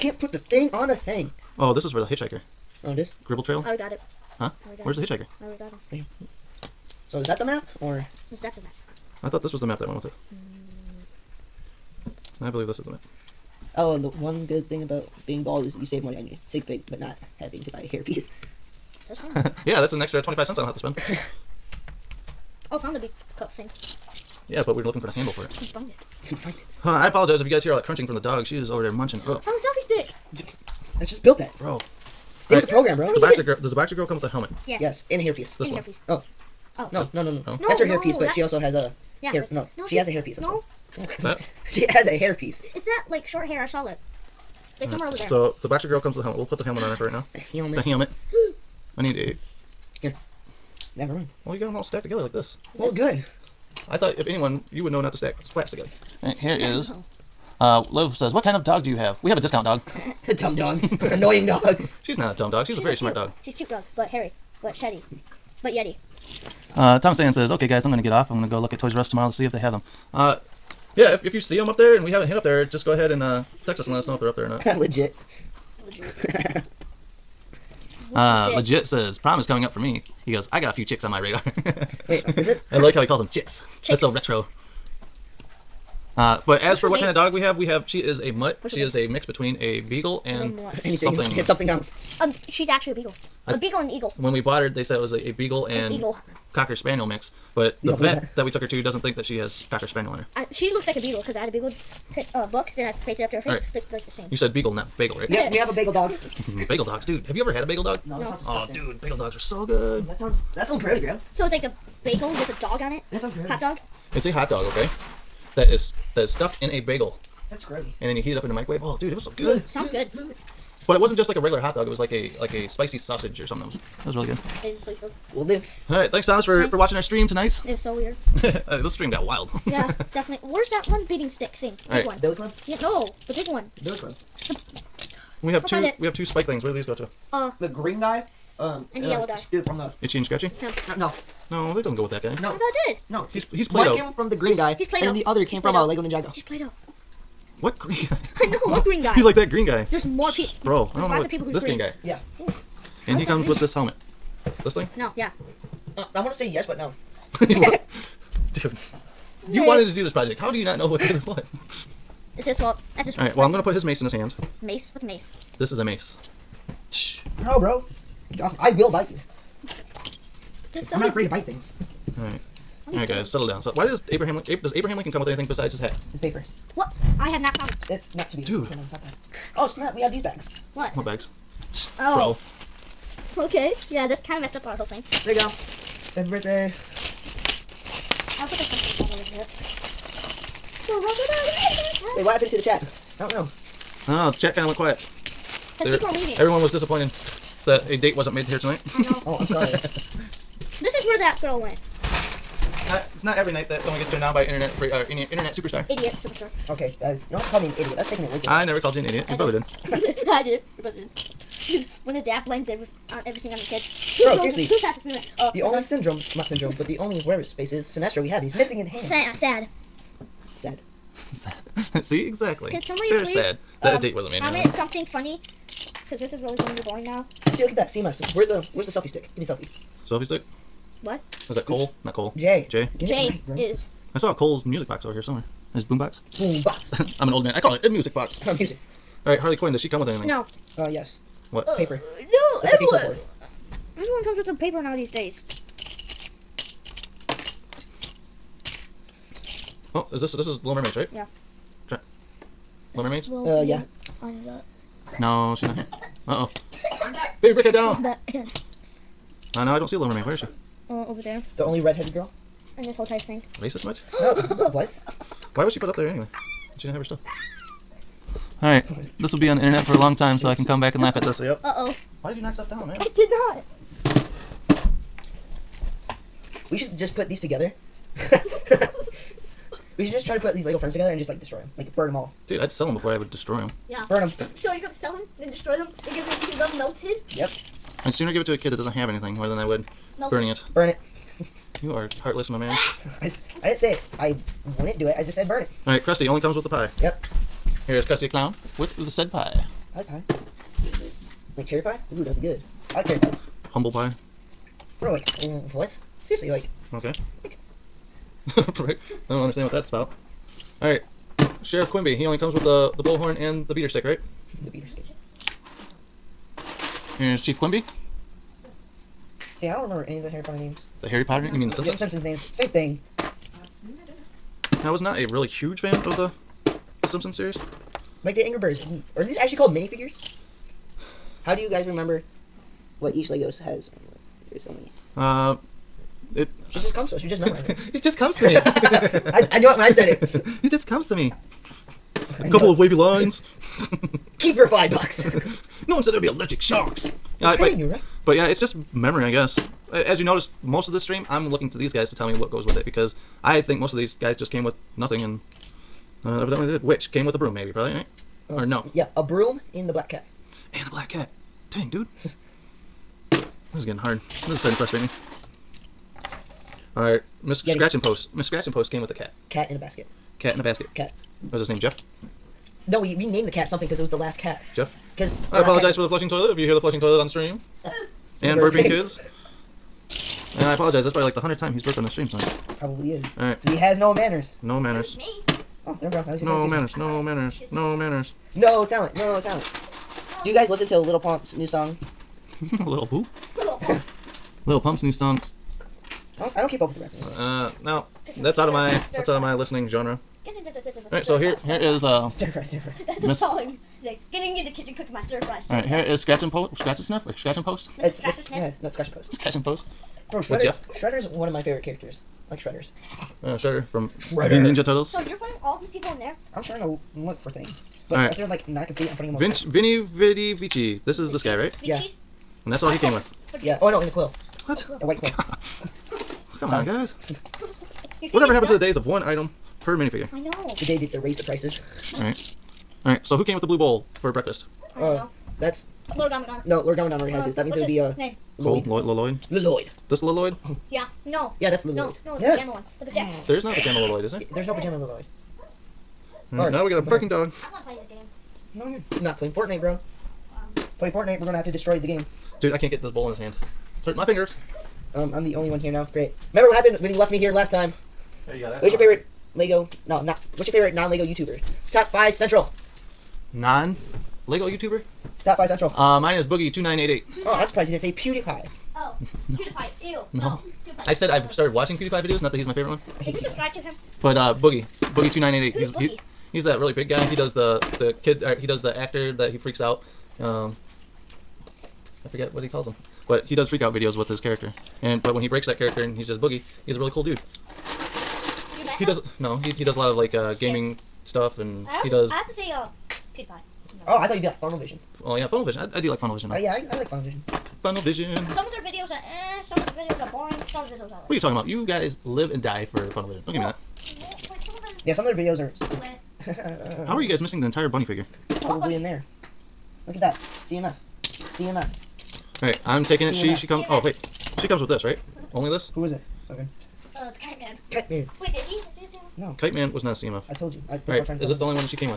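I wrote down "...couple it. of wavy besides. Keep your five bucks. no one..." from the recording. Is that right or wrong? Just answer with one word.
wrong.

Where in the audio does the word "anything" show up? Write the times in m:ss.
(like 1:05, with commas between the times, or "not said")
1:30, 2:55, 4:00, 4:49.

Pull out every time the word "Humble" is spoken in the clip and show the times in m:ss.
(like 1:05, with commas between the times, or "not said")
5:03.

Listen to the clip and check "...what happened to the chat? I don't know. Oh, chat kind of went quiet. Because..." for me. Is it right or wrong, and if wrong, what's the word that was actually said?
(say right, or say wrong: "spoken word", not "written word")
right.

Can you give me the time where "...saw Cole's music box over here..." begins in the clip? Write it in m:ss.
3:54.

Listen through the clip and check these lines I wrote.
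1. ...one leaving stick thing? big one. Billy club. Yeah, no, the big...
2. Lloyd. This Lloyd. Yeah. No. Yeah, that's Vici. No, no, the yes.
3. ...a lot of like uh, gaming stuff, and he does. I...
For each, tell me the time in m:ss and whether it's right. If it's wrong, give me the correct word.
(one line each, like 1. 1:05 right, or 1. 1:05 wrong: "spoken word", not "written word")
1. 2:10 wrong: "beating", not "leaving"
2. 7:19 wrong: "Lloyd", not "Vici"
3. 8:09 right.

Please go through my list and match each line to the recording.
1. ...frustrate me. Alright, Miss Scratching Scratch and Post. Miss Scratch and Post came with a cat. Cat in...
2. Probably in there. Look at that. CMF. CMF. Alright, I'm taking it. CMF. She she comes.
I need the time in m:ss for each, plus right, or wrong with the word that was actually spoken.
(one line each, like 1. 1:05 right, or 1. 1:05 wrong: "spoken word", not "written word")
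1. 6:04 right
2. 8:28 right.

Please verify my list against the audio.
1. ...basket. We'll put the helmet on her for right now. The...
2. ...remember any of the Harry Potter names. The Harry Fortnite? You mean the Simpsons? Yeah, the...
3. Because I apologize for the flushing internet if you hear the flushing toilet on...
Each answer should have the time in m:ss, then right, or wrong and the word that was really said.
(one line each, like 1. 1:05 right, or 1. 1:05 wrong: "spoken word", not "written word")
1. 0:46 wrong: "helmet", not "basket"
2. 5:19 wrong: "Potter", not "Fortnite"
3. 6:15 wrong: "toilet", not "internet".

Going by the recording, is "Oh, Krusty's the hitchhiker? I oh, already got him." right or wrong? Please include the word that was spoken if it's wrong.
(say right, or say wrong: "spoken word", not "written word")
wrong: "Where", not "Krusty".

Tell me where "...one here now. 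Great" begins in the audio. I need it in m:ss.
7:35.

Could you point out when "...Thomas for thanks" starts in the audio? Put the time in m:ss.
2:06.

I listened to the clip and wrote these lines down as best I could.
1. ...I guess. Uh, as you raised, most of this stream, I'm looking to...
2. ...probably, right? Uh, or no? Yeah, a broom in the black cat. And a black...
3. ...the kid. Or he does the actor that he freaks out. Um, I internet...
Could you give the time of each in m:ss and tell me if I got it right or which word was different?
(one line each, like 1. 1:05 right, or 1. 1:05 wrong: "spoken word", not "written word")
1. 5:49 wrong: "noticed", not "raised"
2. 5:57 right
3. 7:57 wrong: "forget", not "internet".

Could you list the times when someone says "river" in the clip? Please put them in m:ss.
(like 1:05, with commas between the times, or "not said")
not said.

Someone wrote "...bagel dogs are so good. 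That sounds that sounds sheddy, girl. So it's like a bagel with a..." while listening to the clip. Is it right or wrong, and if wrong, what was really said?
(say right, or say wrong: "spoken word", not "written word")
wrong: "grody", not "sheddy".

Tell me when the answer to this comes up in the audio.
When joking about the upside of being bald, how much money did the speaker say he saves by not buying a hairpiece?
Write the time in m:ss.
0:20.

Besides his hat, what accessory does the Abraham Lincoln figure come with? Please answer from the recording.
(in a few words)
His papers.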